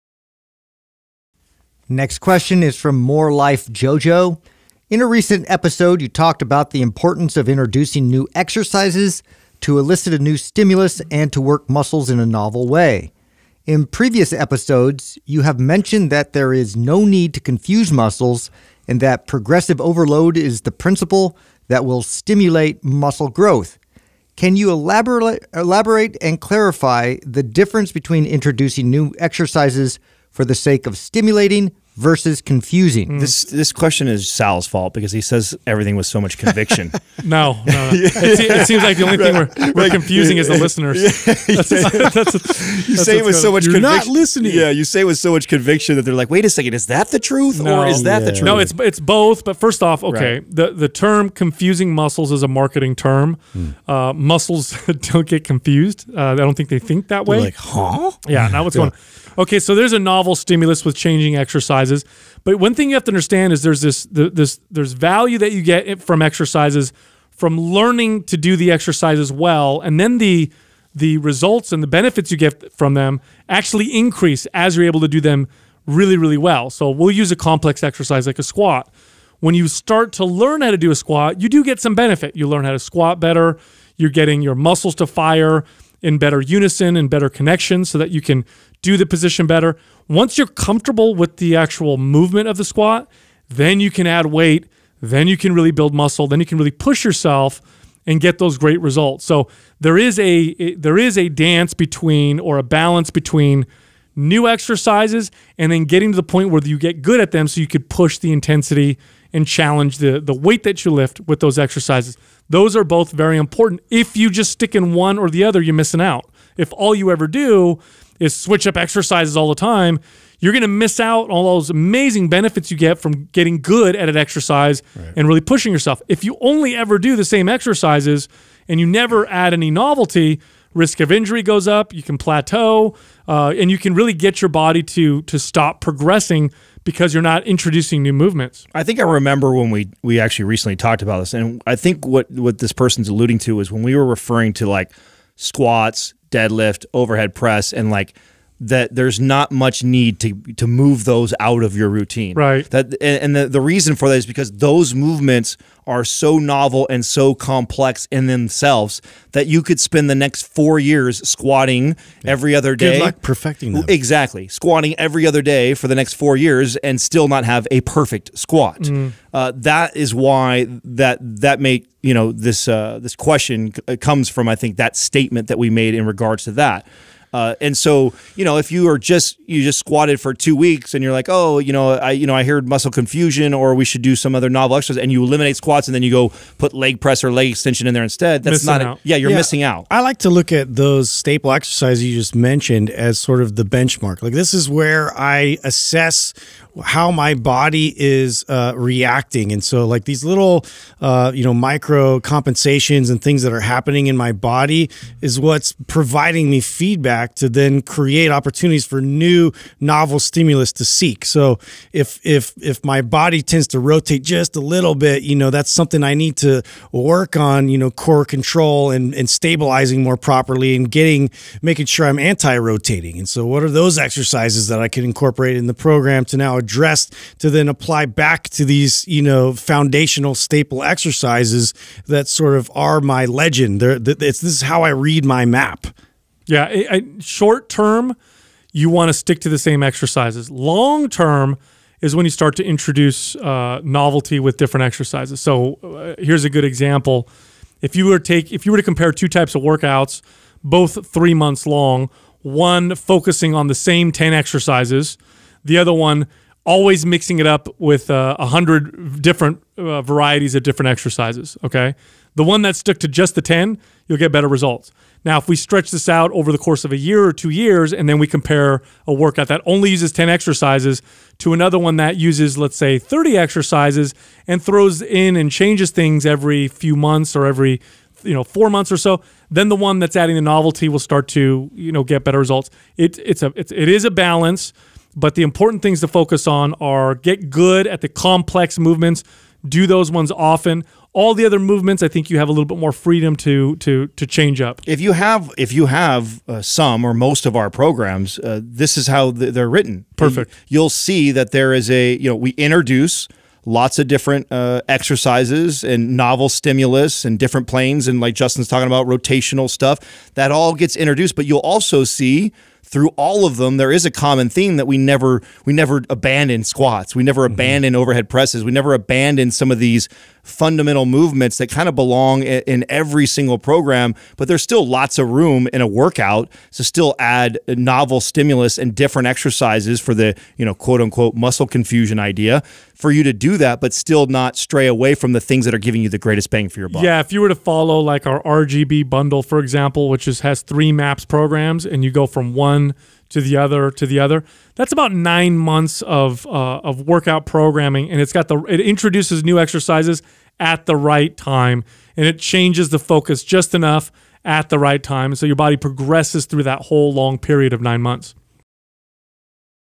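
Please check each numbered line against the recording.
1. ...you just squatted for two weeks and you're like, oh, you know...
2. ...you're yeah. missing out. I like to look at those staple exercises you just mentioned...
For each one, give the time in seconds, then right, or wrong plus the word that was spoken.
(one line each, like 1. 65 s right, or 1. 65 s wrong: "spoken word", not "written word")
1. 179 s right
2. 189 s right.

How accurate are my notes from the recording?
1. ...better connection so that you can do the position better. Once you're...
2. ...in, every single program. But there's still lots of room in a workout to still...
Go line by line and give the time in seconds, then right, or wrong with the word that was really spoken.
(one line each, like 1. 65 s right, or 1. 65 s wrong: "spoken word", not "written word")
1. 87 s right
2. 322 s right.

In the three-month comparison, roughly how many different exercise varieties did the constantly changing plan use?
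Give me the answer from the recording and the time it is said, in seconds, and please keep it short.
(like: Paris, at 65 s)
100, at 258 s.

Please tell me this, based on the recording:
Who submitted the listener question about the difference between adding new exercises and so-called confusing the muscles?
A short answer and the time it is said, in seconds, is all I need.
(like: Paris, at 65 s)
More Life JoJo, at 3 s.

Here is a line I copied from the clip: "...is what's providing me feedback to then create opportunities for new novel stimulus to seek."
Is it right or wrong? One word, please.
right.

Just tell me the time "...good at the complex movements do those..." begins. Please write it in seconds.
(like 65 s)
287 s.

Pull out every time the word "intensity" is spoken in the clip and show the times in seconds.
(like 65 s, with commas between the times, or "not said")
108 s.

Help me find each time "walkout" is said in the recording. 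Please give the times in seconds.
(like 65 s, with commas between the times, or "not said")
not said.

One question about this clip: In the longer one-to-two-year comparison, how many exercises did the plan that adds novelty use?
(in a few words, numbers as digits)
30.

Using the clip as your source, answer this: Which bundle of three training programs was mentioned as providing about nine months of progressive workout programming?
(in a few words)
RGB bundle.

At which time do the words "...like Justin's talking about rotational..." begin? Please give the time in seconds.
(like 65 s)
308 s.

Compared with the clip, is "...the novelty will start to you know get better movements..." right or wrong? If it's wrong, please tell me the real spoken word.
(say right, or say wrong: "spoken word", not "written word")
wrong: "results", not "movements".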